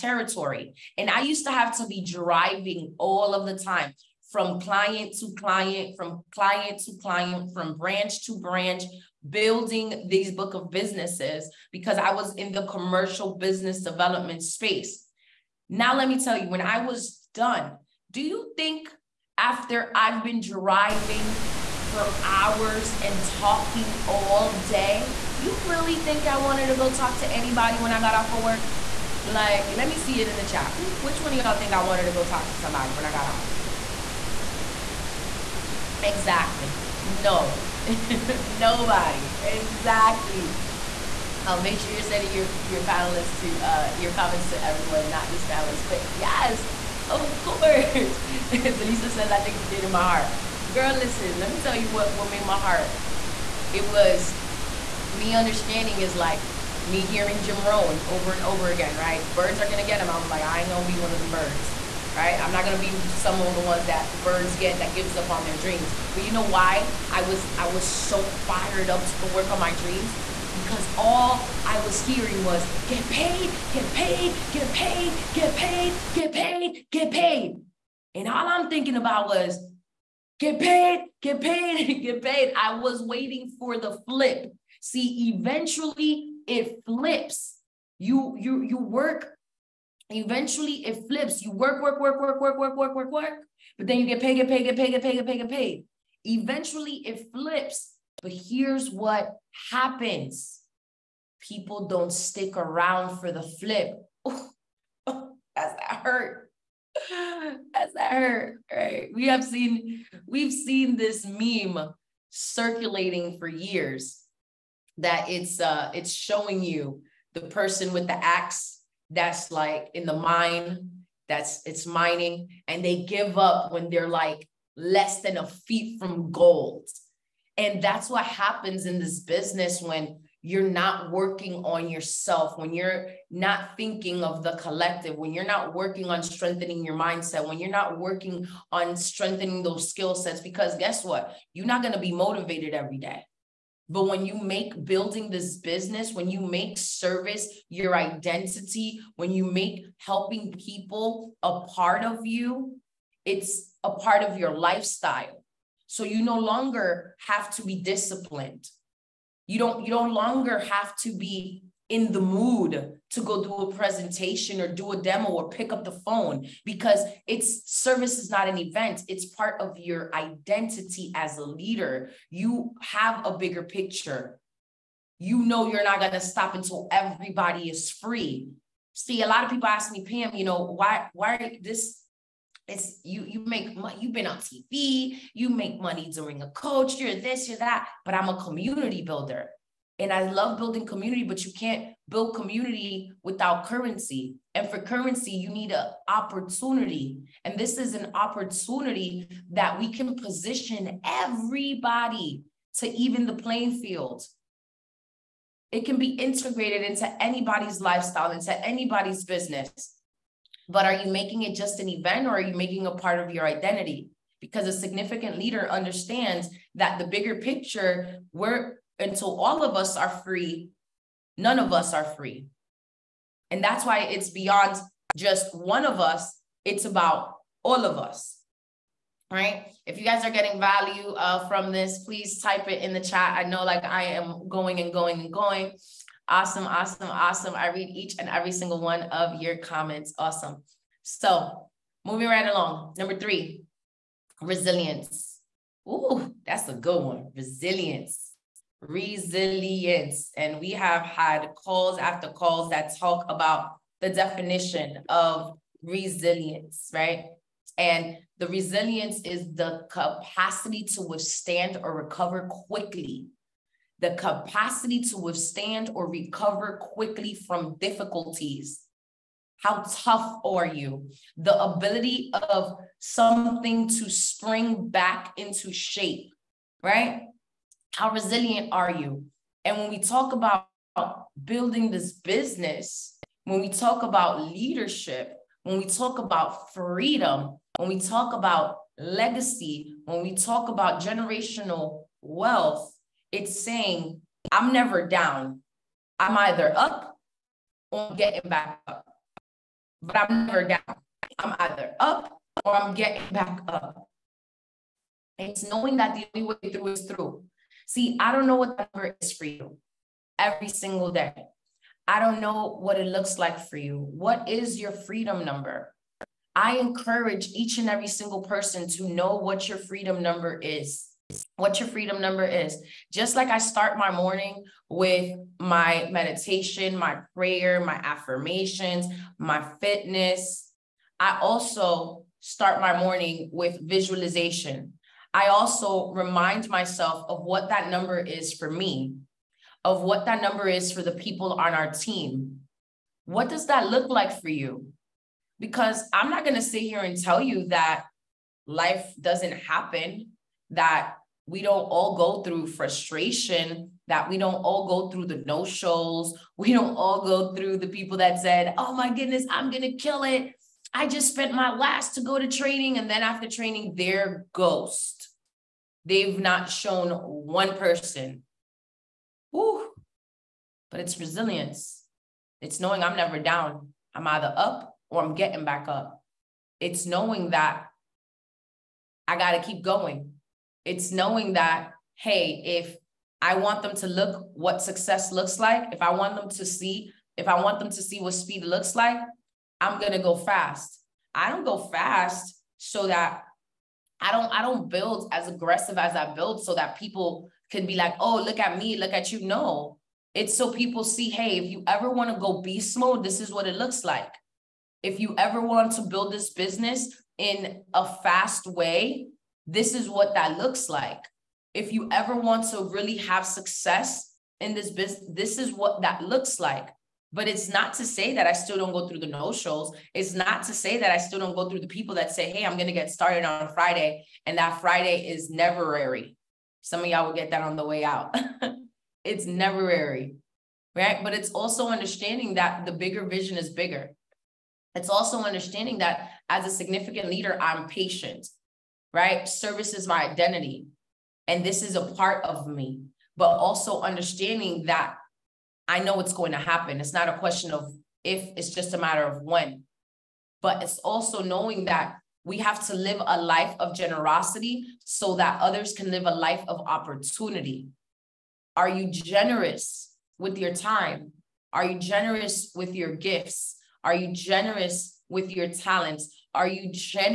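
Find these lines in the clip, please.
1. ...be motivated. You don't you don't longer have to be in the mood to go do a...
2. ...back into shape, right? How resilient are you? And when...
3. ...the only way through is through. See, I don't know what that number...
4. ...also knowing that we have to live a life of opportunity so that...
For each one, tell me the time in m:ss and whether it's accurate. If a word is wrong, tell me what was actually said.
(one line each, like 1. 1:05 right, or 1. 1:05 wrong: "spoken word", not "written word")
1. 2:37 wrong: "disciplined", not "motivated"
2. 4:34 right
3. 5:06 right
4. 7:30 wrong: "generosity", not "opportunity".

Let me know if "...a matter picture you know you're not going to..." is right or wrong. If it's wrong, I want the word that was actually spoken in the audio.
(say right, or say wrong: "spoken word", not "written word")
wrong: "bigger", not "matter".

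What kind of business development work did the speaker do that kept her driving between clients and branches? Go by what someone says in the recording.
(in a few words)
Commercial business development.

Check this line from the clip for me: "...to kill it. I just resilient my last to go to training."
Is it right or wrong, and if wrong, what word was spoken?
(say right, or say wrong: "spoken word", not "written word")
wrong: "spent", not "resilient".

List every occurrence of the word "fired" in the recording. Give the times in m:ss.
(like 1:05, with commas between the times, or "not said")
1:08.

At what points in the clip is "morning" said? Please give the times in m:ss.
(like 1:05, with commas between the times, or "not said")
5:24, 5:32.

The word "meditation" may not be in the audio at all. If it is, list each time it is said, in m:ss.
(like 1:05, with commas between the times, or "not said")
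5:26.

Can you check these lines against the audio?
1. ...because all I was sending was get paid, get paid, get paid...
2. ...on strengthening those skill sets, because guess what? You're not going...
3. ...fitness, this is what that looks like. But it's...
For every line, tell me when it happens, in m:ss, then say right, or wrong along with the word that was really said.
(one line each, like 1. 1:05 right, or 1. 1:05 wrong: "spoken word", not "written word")
1. 1:10 wrong: "hearing", not "sending"
2. 2:18 right
3. 6:54 wrong: "business", not "fitness".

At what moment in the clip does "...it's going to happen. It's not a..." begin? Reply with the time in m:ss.
7:26.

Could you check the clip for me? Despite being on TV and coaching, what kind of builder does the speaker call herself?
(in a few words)
Community builder.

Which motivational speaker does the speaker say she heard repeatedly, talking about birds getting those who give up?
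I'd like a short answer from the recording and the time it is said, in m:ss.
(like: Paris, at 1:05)
Jim Rohn, at 0:57.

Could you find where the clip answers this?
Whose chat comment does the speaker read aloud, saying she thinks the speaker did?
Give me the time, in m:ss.
0:48.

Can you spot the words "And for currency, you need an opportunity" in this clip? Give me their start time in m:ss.
3:14.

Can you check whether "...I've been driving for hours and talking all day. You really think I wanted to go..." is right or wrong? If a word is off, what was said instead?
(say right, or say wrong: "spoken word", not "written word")
right.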